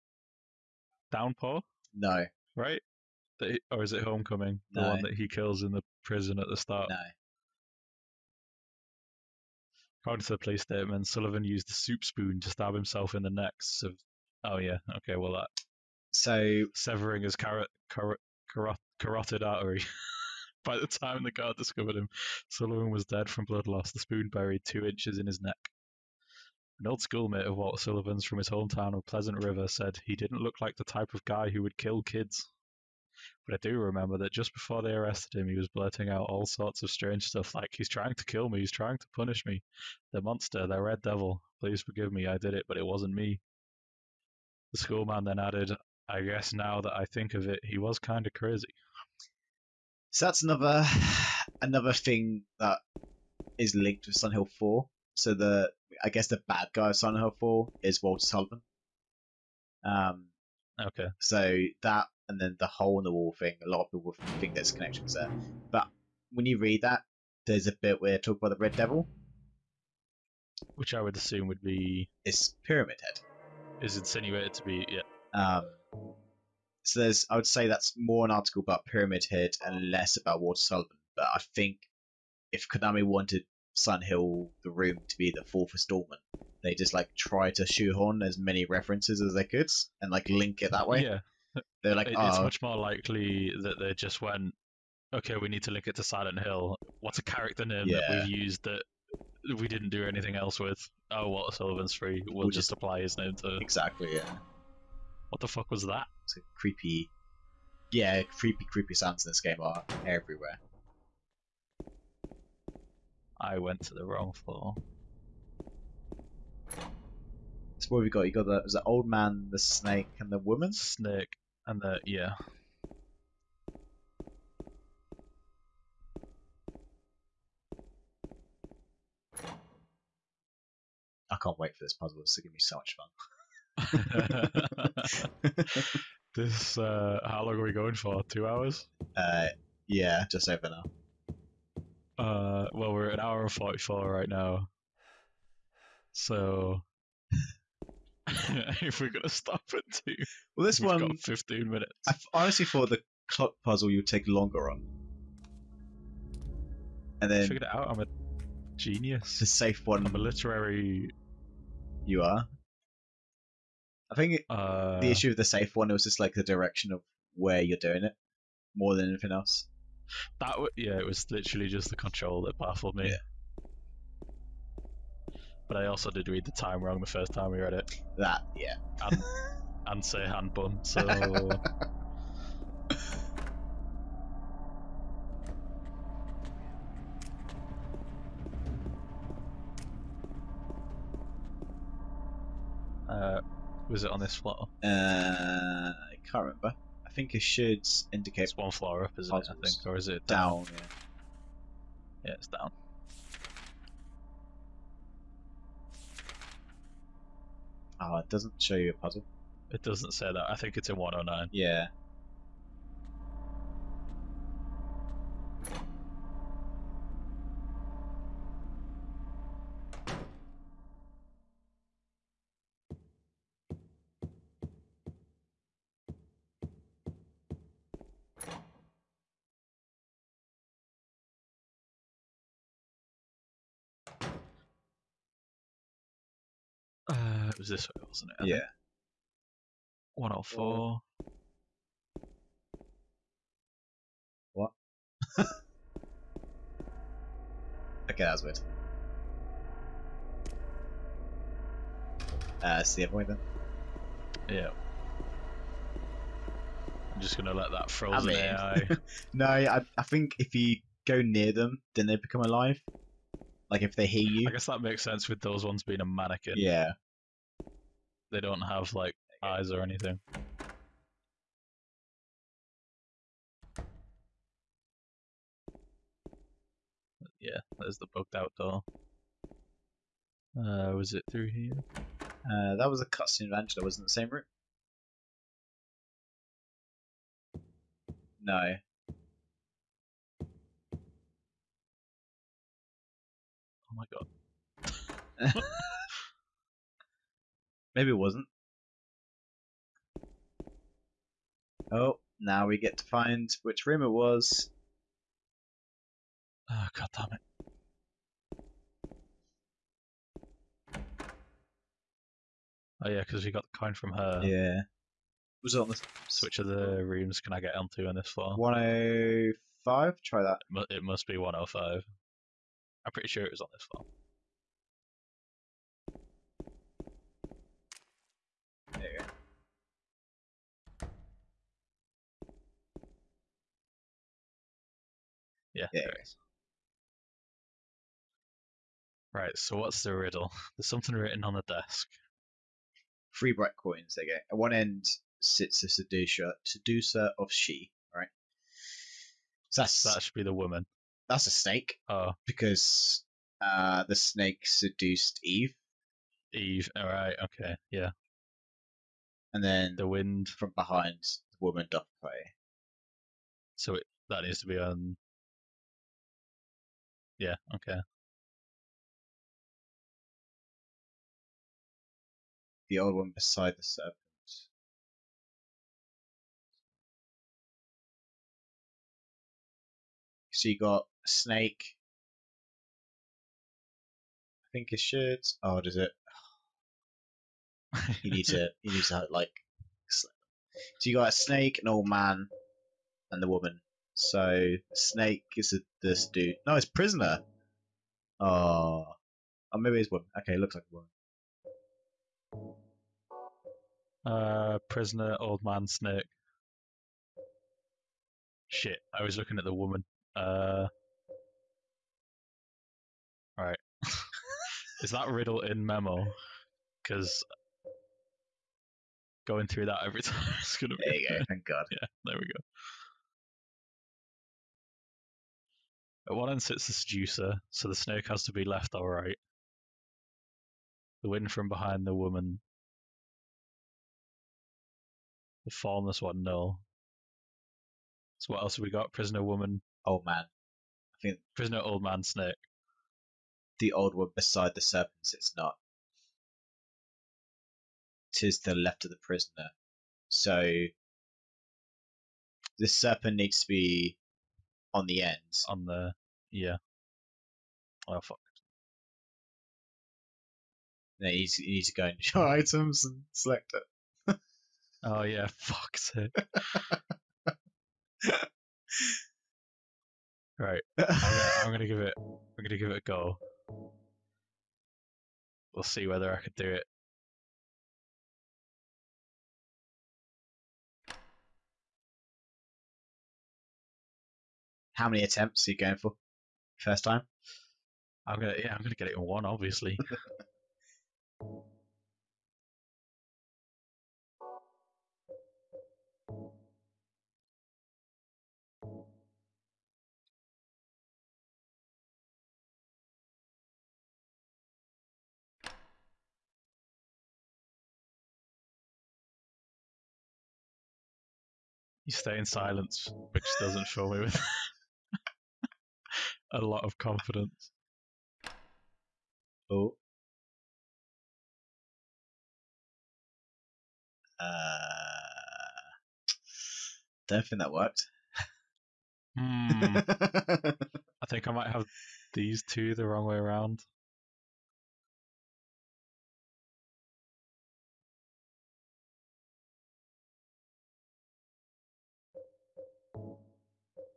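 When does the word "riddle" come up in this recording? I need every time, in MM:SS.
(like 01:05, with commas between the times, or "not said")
05:40, 06:55.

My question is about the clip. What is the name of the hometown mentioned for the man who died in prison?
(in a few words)
Pleasant River.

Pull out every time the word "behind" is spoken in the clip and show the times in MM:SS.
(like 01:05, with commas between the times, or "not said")
06:00, 07:11.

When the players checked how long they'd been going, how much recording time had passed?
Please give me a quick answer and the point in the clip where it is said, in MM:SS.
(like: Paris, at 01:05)
1 hour 44 minutes, at 02:23.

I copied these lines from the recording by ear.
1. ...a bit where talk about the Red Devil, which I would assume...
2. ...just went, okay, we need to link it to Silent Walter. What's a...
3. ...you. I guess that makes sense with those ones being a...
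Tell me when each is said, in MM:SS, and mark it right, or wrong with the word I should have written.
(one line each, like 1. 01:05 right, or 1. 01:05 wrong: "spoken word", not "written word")
1. 01:07 right
2. 01:33 wrong: "Hill", not "Walter"
3. 04:24 right.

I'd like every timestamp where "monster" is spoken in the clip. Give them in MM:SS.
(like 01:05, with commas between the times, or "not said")
00:40.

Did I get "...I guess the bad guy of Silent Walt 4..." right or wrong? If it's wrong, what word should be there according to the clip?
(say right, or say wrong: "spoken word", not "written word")
wrong: "Hill", not "Walt".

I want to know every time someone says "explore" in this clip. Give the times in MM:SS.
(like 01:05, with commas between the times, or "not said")
not said.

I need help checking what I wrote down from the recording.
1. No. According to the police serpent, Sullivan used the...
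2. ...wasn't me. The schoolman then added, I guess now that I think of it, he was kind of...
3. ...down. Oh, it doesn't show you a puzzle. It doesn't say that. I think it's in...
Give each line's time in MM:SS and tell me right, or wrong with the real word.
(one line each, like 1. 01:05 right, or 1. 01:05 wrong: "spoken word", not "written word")
1. 00:06 wrong: "statement", not "serpent"
2. 00:42 right
3. 03:22 right.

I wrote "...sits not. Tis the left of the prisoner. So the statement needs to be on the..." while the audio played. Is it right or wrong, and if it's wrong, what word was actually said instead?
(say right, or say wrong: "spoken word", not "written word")
wrong: "serpent", not "statement".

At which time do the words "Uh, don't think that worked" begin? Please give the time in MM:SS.
08:44.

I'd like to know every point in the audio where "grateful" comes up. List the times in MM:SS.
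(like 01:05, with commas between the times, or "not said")
not said.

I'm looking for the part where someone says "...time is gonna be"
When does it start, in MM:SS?
07:00.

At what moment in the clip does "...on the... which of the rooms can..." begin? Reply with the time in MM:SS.
05:15.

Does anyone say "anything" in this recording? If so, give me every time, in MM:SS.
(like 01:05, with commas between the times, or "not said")
01:40, 02:49, 04:29.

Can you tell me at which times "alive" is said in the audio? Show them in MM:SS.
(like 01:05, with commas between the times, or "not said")
04:22.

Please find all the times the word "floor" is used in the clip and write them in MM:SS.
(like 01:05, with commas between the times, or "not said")
01:54, 03:14, 03:18, 05:18, 05:23.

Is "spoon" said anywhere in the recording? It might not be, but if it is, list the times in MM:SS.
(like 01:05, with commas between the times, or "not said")
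00:12, 00:23.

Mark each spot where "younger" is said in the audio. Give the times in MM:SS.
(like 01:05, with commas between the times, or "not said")
not said.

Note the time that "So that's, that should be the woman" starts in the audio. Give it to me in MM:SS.
05:49.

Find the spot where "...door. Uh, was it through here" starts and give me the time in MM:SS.
04:38.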